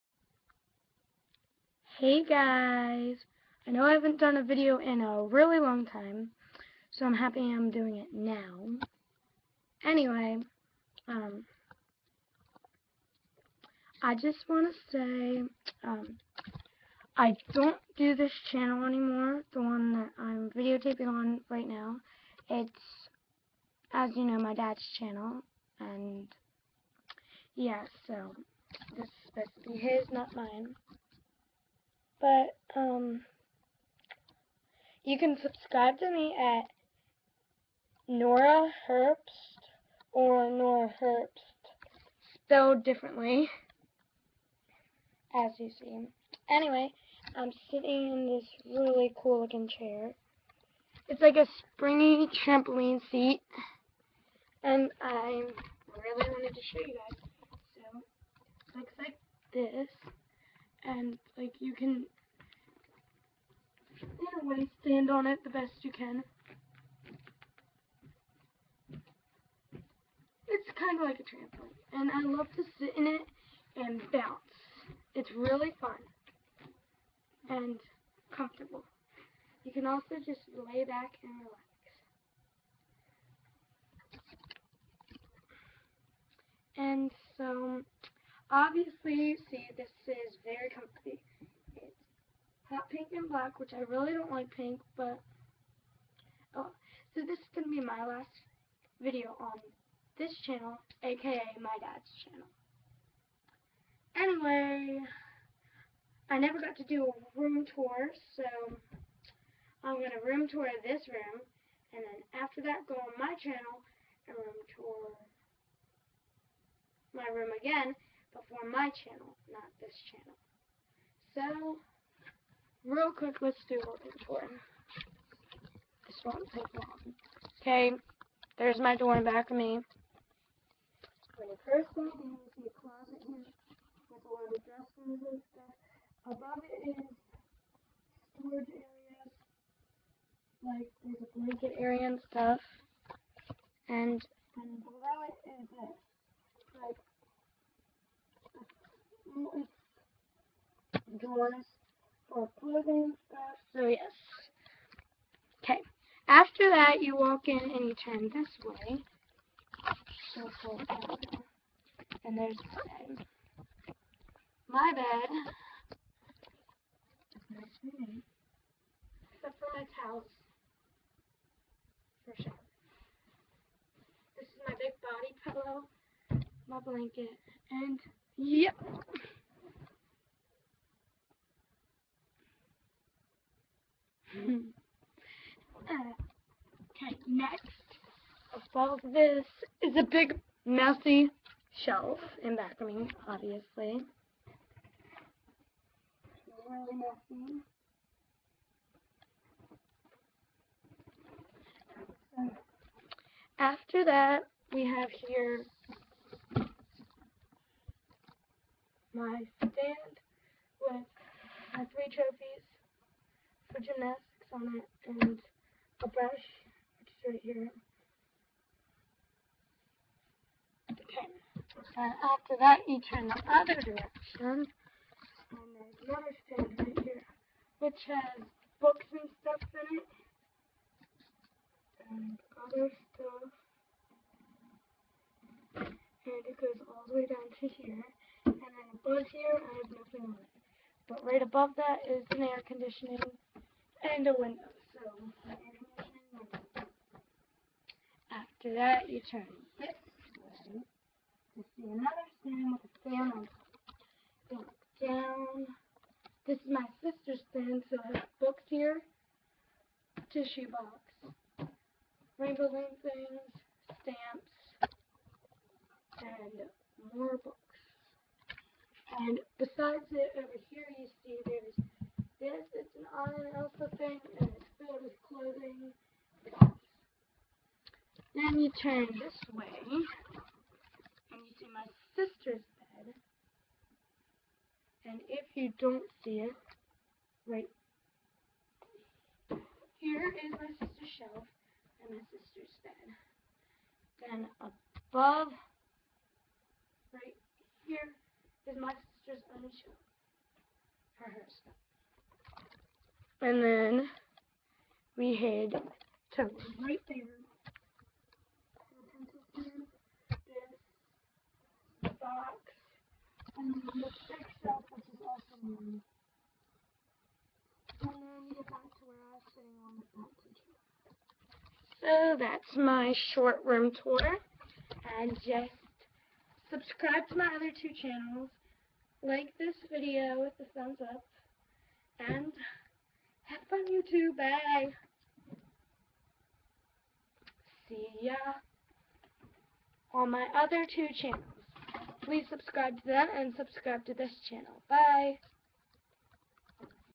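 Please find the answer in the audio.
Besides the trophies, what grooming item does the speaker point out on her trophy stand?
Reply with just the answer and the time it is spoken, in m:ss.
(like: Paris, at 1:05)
A brush, at 3:36.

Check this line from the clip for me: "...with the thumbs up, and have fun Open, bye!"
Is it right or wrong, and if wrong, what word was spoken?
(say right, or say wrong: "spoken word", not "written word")
wrong: "YouTube", not "Open".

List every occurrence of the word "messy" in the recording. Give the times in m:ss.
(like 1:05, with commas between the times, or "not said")
3:10, 3:16.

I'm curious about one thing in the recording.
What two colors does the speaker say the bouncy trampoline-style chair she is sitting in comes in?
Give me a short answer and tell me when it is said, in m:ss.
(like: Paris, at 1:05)
Hot pink and black, at 1:32.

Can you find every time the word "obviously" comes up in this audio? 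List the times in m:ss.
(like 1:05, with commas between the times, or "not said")
1:28, 3:13.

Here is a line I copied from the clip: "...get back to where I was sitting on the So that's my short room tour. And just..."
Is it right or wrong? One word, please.
right.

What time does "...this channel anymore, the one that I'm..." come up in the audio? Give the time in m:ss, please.
0:18.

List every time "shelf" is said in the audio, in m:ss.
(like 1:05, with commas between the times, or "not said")
3:11, 4:51.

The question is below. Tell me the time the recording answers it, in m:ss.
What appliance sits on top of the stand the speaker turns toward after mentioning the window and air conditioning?
4:12.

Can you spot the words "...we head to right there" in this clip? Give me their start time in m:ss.
5:05.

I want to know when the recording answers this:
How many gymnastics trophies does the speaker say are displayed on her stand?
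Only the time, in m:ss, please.
3:31.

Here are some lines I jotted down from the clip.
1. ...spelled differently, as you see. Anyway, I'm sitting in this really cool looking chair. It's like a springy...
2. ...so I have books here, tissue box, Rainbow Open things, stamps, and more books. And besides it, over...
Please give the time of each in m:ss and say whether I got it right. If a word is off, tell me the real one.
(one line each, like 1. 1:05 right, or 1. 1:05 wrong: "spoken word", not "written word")
1. 0:42 right
2. 4:17 wrong: "Loom", not "Open".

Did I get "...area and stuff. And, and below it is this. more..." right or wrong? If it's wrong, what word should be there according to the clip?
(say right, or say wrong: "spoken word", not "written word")
right.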